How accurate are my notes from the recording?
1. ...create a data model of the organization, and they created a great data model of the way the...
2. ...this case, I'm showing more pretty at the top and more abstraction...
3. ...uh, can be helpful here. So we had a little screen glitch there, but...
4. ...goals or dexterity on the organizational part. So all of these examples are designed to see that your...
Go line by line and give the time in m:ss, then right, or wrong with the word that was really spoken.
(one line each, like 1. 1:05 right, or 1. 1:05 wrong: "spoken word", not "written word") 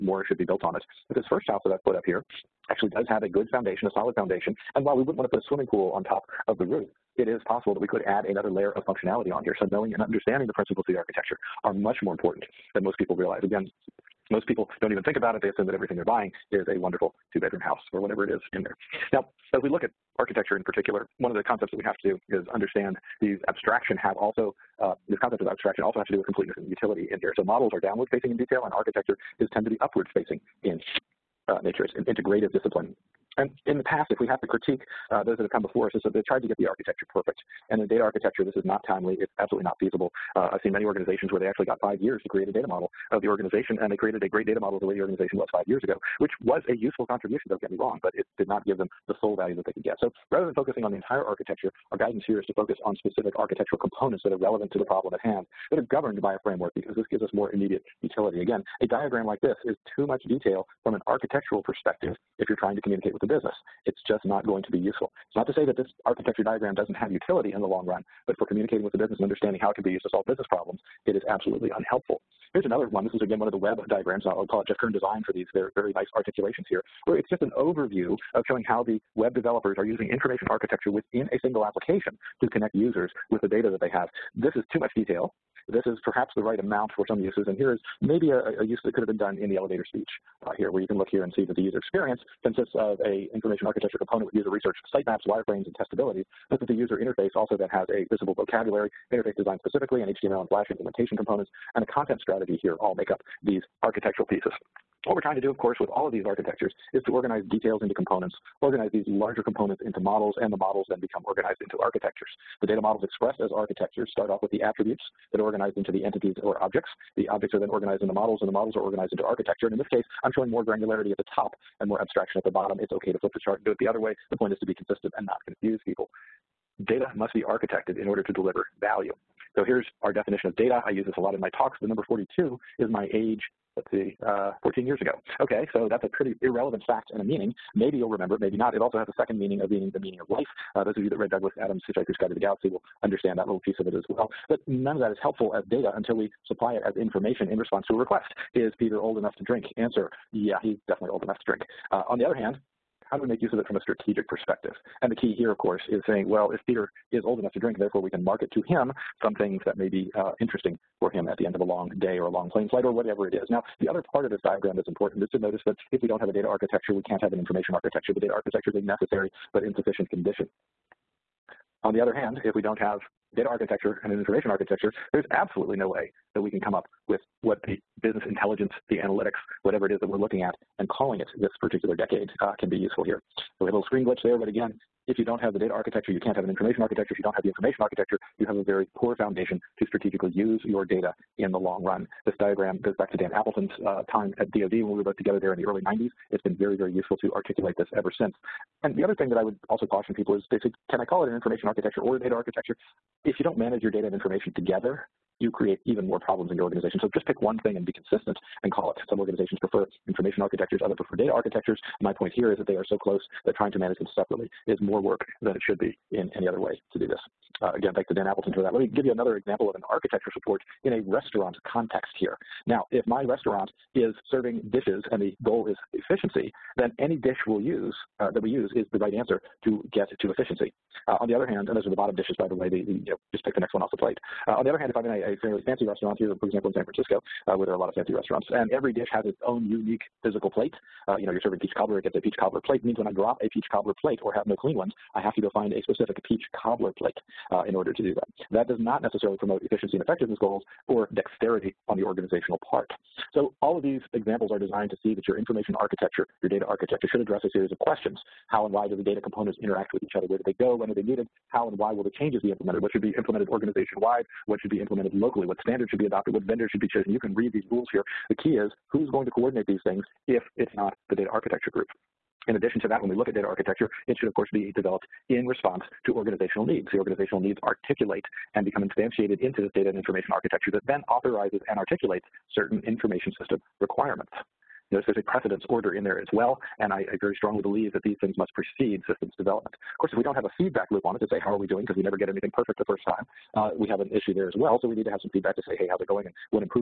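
1. 0:42 right
2. 1:59 wrong: "granularity", not "pretty"
3. 3:02 wrong: "useful", not "helpful"
4. 4:10 right.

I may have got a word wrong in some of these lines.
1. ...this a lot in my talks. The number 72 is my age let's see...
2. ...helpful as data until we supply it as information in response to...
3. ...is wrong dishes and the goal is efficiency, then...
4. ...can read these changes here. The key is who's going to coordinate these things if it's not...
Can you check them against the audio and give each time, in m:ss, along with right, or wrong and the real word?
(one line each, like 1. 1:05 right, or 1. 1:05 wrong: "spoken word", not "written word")
1. 2:11 wrong: "42", not "72"
2. 2:25 right
3. 3:43 wrong: "serving", not "wrong"
4. 4:27 wrong: "rules", not "changes".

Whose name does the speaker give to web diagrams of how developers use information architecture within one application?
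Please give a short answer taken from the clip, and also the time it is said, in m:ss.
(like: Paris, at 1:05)
Jeff Kern, at 1:14.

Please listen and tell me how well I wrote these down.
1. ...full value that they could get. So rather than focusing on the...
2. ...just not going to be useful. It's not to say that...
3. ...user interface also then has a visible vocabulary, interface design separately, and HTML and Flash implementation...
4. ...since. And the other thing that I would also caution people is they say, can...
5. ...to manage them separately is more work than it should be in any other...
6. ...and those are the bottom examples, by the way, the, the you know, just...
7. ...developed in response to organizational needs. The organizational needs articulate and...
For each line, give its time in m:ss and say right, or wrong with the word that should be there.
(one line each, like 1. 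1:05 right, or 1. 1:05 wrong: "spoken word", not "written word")
1. 0:49 right
2. 1:04 right
3. 1:36 wrong: "specifically", not "separately"
4. 3:18 right
5. 3:33 right
6. 3:51 wrong: "dishes", not "examples"
7. 4:34 right.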